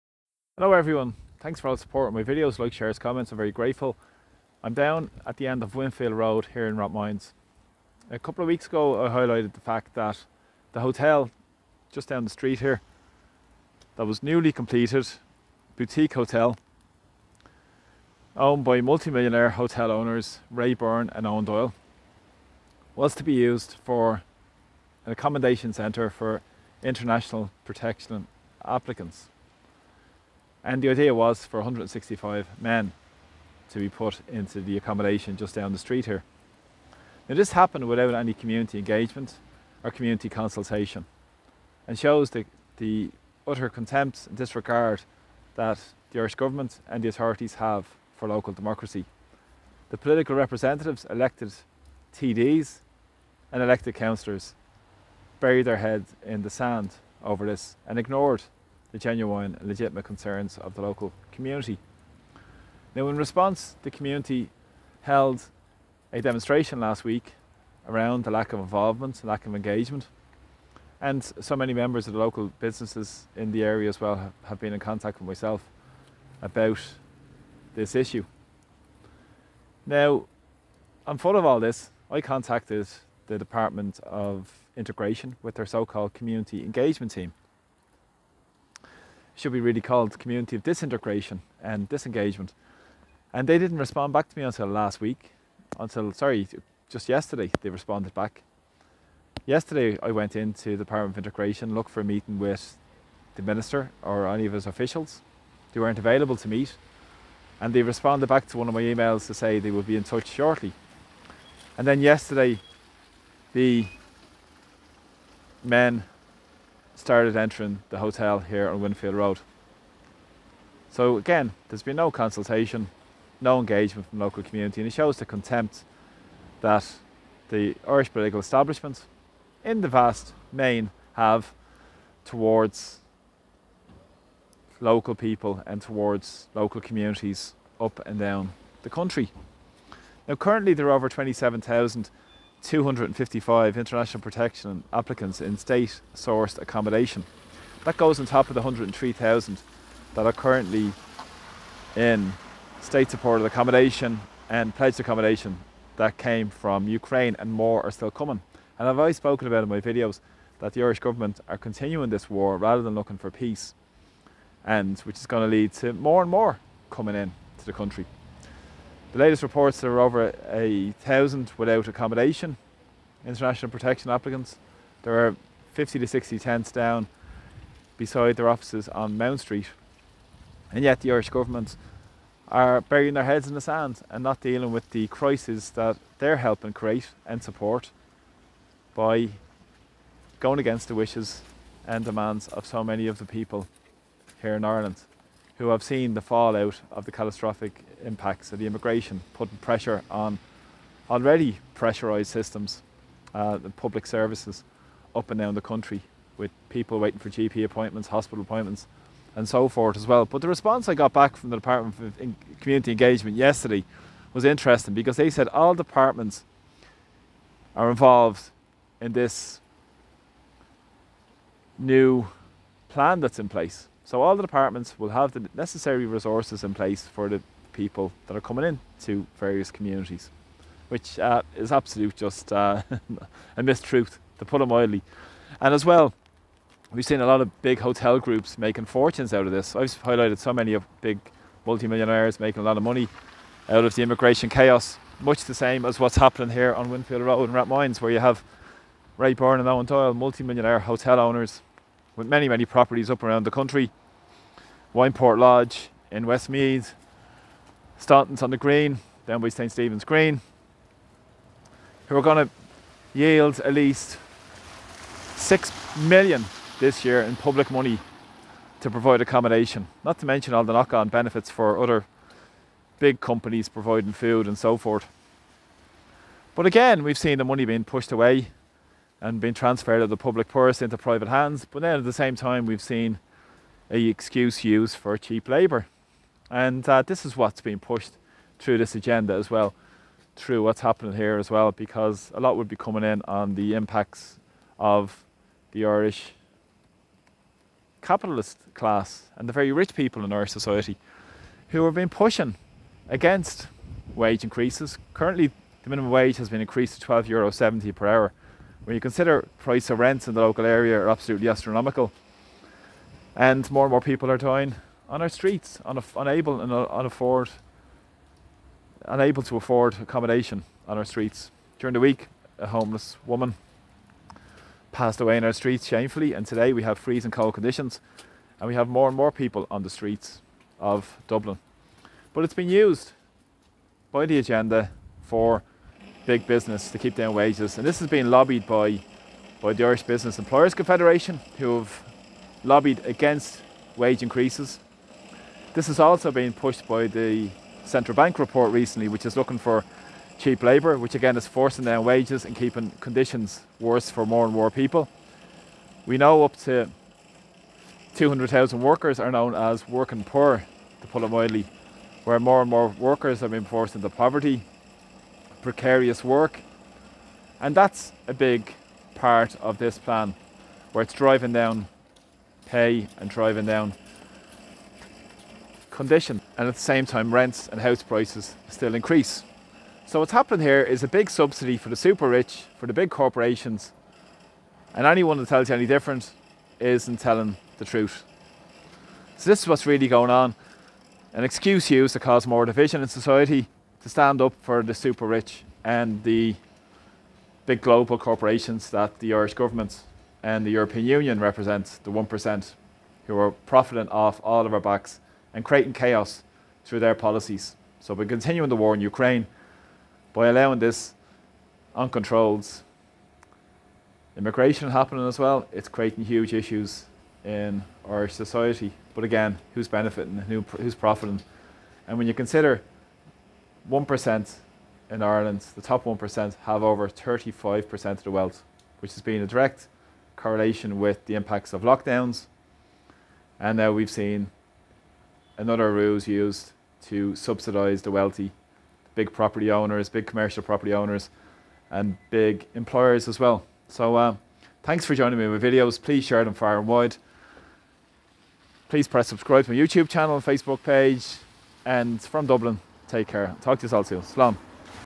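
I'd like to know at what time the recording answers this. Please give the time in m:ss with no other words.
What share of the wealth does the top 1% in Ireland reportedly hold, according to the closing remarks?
7:06.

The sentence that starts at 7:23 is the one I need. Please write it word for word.
So uh, thanks for joining me with videos.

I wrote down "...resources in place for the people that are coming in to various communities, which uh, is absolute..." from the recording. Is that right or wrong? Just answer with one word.
right.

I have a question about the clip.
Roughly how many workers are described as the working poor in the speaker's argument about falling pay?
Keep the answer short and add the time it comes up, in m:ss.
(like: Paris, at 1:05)
200,000, at 5:58.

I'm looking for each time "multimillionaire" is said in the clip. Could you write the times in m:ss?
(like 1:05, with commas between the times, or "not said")
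0:18, 4:01, 4:10.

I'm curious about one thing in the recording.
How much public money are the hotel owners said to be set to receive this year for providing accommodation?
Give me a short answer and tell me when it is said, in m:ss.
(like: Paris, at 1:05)
6 million, at 4:25.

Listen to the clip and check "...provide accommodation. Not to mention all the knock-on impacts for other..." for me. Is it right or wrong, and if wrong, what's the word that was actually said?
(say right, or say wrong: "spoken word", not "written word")
wrong: "benefits", not "impacts".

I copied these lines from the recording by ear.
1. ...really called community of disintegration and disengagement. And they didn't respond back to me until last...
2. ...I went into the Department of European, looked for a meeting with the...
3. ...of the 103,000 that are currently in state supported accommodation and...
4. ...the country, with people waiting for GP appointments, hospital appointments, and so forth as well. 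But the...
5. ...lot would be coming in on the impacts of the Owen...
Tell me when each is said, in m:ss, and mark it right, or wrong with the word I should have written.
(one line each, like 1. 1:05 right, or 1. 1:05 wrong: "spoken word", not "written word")
1. 1:29 right
2. 1:40 wrong: "Integration", not "European"
3. 2:28 right
4. 3:25 right
5. 4:52 wrong: "Irish", not "Owen".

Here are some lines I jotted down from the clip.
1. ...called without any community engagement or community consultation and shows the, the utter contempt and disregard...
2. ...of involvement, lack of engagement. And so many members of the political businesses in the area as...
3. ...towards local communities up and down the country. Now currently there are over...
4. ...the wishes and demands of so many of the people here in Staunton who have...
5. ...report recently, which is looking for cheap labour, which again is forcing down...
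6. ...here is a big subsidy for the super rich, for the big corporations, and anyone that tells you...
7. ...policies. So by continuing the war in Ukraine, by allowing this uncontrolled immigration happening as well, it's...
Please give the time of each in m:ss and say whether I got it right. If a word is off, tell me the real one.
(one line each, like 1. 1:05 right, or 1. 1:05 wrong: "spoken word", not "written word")
1. 0:37 wrong: "happened", not "called"
2. 1:08 wrong: "local", not "political"
3. 2:15 right
4. 3:10 wrong: "Ireland", not "Staunton"
5. 5:48 right
6. 6:20 right
7. 6:47 right.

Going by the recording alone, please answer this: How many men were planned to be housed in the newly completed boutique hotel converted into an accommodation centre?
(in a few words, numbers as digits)
165.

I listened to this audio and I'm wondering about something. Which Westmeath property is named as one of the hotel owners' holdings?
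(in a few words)
Wineport Lodge.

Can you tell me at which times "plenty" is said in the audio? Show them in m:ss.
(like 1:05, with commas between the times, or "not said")
not said.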